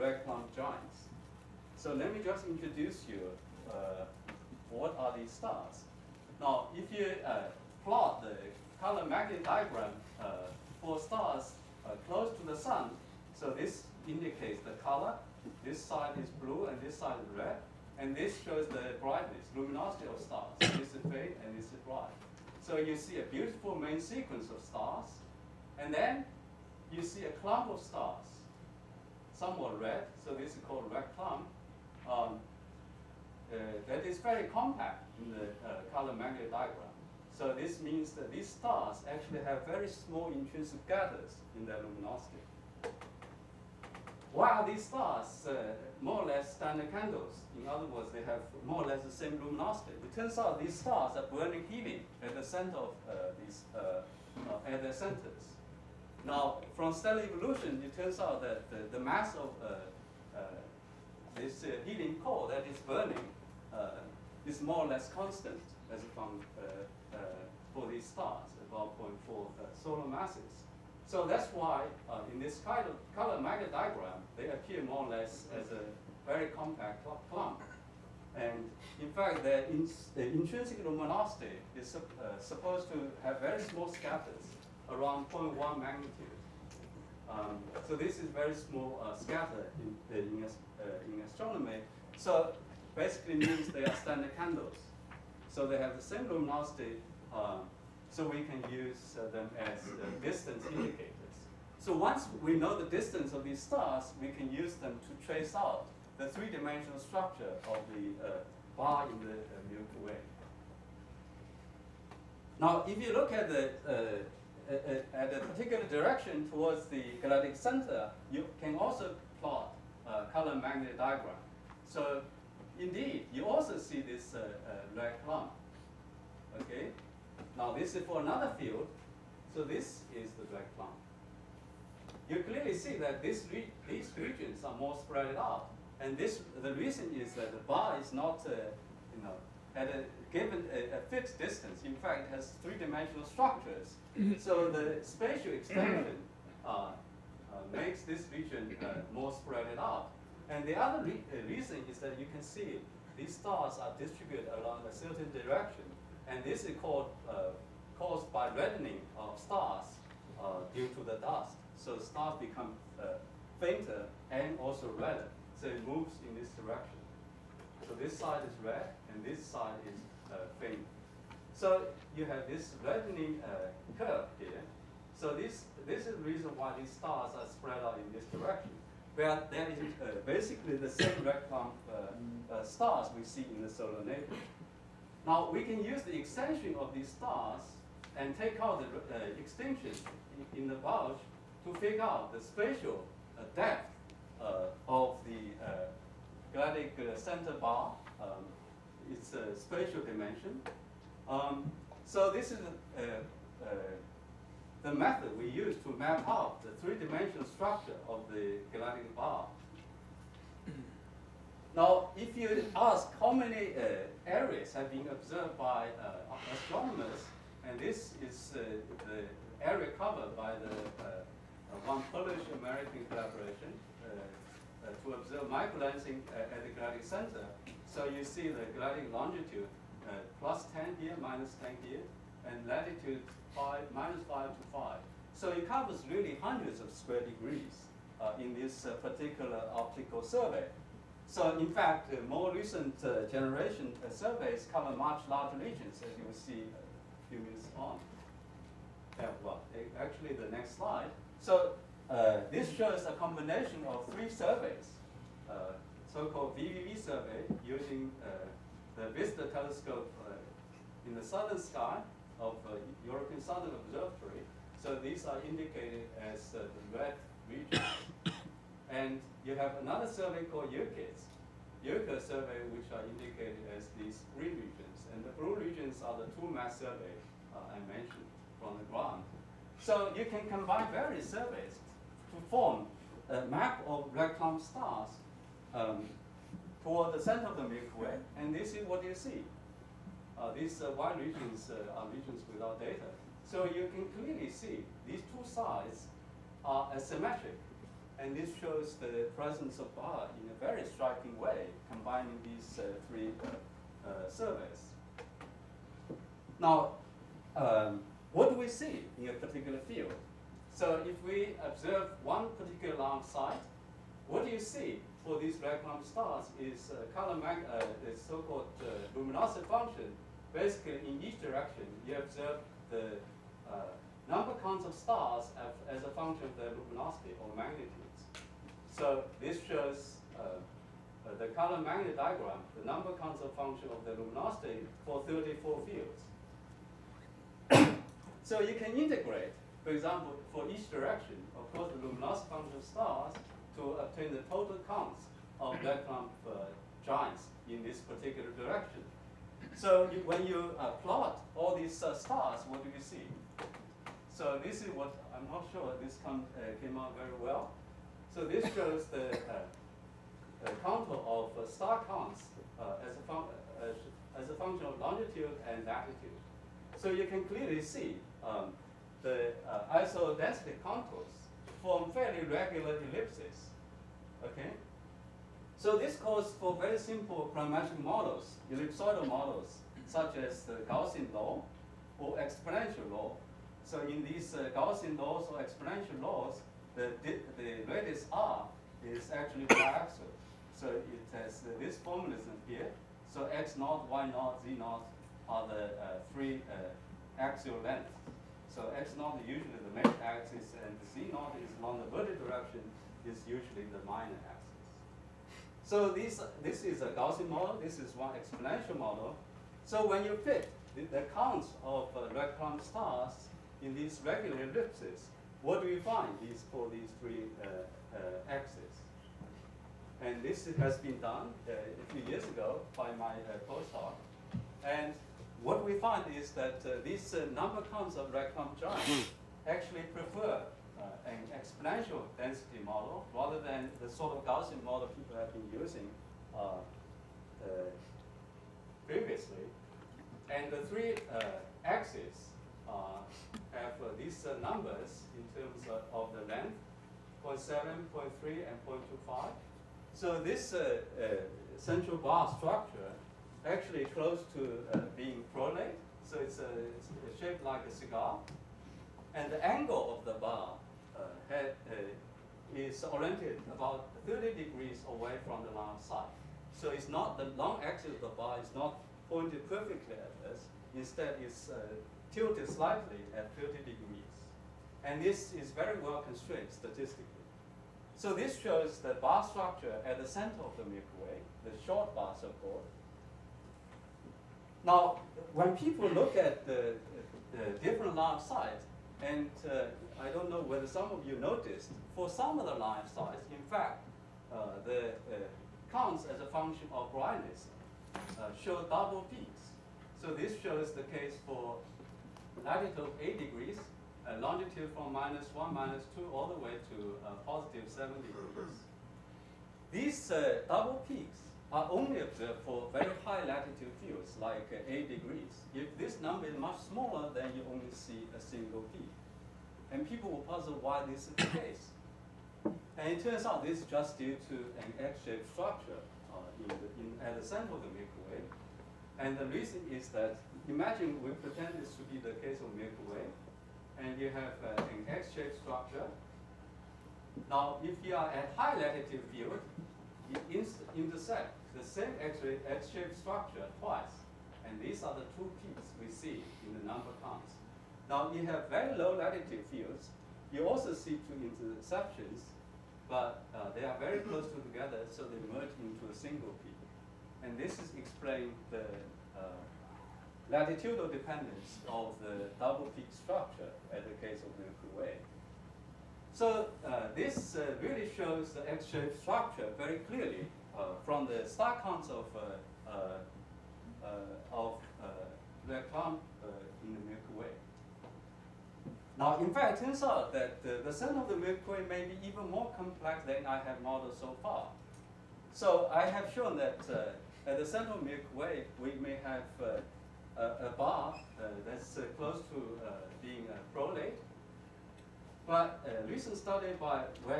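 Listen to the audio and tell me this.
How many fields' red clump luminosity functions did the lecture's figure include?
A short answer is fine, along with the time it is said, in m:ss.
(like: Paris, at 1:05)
34, at 5:35.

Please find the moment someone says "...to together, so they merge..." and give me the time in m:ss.
9:14.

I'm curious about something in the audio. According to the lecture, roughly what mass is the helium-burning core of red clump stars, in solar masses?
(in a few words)
0.4.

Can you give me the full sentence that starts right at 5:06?
Now, um, what do we see in a particular field?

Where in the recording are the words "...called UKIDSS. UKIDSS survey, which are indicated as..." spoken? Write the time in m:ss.
4:30.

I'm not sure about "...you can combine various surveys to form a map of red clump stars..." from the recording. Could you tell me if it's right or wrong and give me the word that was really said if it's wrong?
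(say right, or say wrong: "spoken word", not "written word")
right.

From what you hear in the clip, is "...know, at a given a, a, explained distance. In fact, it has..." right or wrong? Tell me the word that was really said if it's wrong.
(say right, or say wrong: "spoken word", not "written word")
wrong: "fixed", not "explained".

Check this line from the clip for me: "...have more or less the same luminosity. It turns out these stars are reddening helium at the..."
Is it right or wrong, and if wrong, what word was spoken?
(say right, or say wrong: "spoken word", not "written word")
wrong: "burning", not "reddening".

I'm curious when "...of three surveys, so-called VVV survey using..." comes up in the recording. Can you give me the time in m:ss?
4:13.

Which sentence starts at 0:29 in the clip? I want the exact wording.
Some are red, so this is called red clump.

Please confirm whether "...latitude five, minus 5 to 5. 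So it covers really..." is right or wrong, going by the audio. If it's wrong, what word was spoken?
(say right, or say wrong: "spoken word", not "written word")
right.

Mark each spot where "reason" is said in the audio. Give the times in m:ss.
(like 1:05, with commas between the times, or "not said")
2:16, 2:31, 2:56, 8:49.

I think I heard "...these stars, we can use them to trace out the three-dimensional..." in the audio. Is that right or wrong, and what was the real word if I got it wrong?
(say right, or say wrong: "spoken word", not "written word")
right.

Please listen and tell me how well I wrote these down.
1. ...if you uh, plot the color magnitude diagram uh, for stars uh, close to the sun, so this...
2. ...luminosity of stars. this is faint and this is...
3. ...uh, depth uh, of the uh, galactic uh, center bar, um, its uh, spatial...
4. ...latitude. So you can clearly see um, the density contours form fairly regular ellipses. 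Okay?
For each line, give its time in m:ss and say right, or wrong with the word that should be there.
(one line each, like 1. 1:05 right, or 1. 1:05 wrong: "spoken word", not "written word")
1. 0:06 right
2. 0:19 right
3. 3:13 right
4. 6:05 right.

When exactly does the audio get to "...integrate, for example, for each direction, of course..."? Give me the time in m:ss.
5:38.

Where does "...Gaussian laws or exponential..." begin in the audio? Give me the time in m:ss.
6:24.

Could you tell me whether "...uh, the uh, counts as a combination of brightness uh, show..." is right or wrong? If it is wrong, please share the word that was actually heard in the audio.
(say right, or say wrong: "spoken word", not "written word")
wrong: "function", not "combination".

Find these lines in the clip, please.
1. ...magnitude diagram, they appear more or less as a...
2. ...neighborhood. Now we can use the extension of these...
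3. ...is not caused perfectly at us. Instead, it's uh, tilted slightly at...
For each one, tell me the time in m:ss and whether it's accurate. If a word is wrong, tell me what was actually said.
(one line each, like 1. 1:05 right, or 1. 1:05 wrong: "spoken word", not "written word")
1. 1:13 right
2. 3:04 right
3. 7:48 wrong: "pointed", not "caused".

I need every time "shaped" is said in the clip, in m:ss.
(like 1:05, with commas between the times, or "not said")
7:37, 8:45, 8:55, 9:02, 9:28.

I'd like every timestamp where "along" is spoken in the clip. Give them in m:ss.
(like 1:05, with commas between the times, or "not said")
2:34, 6:41.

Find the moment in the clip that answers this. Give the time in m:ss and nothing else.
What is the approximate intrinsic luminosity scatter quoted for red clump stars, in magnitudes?
1:25.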